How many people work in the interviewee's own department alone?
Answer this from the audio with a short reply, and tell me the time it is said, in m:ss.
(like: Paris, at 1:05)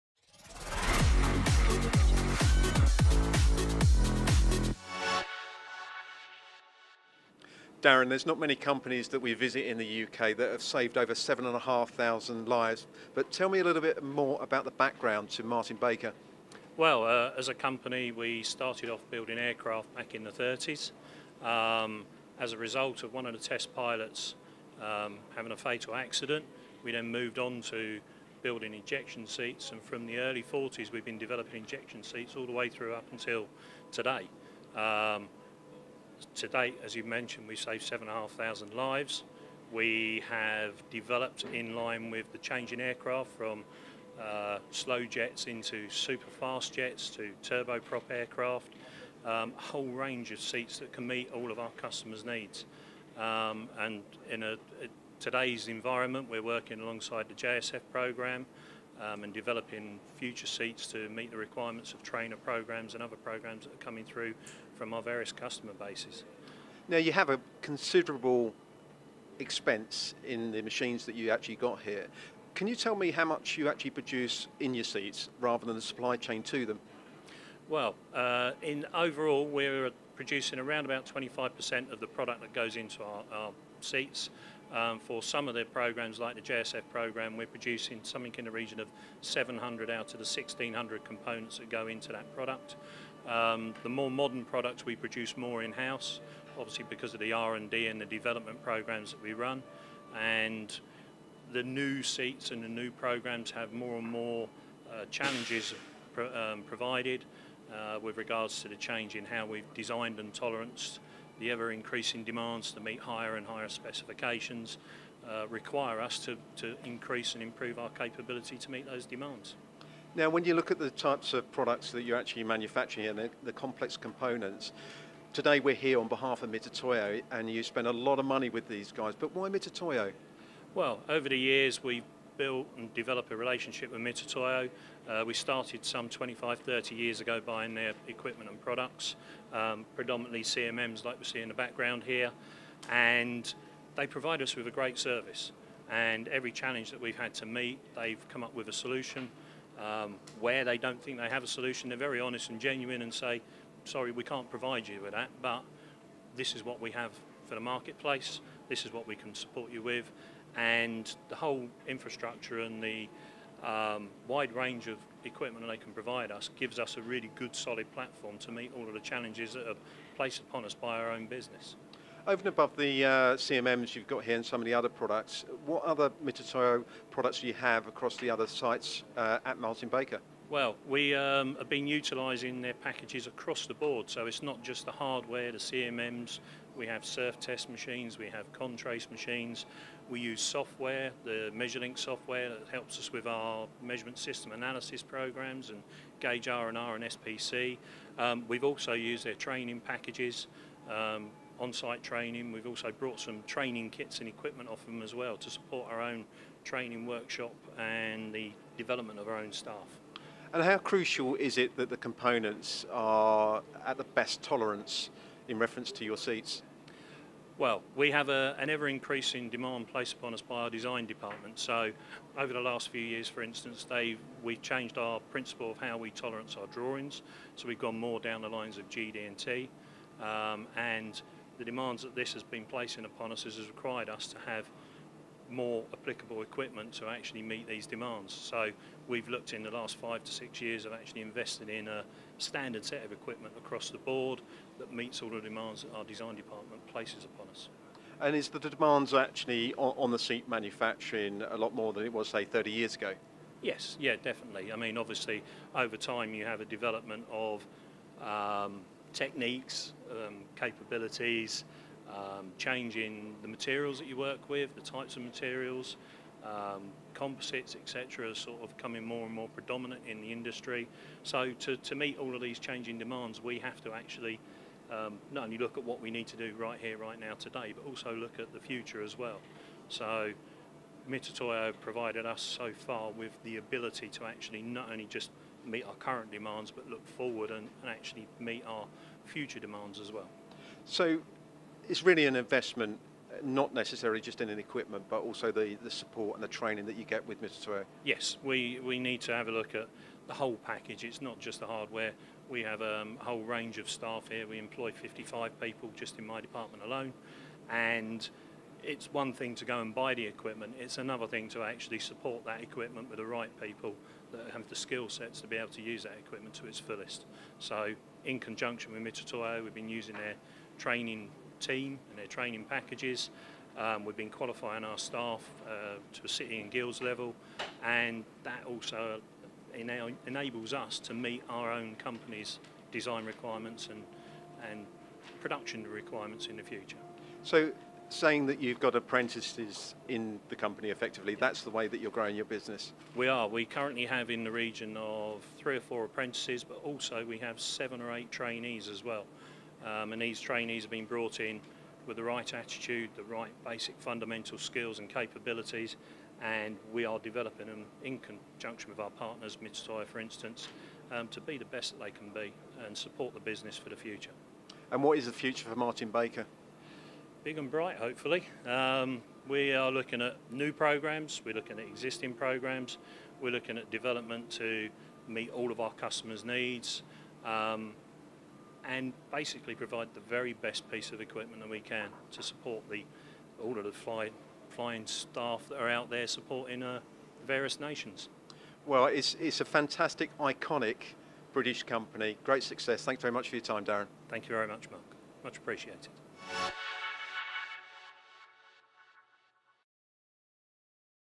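55, at 5:04.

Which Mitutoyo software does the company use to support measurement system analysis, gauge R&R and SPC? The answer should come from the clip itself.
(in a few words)
MeasureLink.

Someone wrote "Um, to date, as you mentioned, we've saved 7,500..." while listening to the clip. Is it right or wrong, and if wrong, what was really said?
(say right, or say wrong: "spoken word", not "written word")
right.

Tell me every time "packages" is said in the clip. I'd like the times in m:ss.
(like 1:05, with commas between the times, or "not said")
3:02, 3:19, 5:00, 5:22.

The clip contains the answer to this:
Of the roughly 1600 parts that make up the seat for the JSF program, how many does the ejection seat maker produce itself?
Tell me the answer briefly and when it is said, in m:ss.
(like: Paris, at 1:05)
700, at 1:29.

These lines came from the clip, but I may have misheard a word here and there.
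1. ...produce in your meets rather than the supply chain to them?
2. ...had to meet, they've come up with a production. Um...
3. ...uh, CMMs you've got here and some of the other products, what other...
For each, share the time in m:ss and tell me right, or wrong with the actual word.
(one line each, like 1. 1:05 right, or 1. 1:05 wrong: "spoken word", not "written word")
1. 1:13 wrong: "seats", not "meets"
2. 2:27 wrong: "solution", not "production"
3. 2:53 right.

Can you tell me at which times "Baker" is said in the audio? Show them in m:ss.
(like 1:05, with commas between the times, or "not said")
0:15, 2:59, 6:06.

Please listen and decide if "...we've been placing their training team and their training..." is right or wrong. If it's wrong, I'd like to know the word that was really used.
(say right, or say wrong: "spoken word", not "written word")
wrong: "using", not "placing".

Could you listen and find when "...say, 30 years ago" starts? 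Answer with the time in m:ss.
4:12.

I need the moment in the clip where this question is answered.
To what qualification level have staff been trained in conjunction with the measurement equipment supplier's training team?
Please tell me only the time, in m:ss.
5:26.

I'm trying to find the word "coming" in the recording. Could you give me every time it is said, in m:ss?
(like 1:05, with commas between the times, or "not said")
1:03, 4:28.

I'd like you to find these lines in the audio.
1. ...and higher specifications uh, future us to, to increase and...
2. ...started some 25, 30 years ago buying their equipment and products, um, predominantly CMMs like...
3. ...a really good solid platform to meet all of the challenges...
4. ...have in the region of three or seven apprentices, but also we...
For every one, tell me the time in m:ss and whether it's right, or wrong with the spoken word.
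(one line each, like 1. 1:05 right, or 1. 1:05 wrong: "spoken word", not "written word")
1. 1:53 wrong: "require", not "future"
2. 2:15 right
3. 2:46 right
4. 5:44 wrong: "four", not "seven".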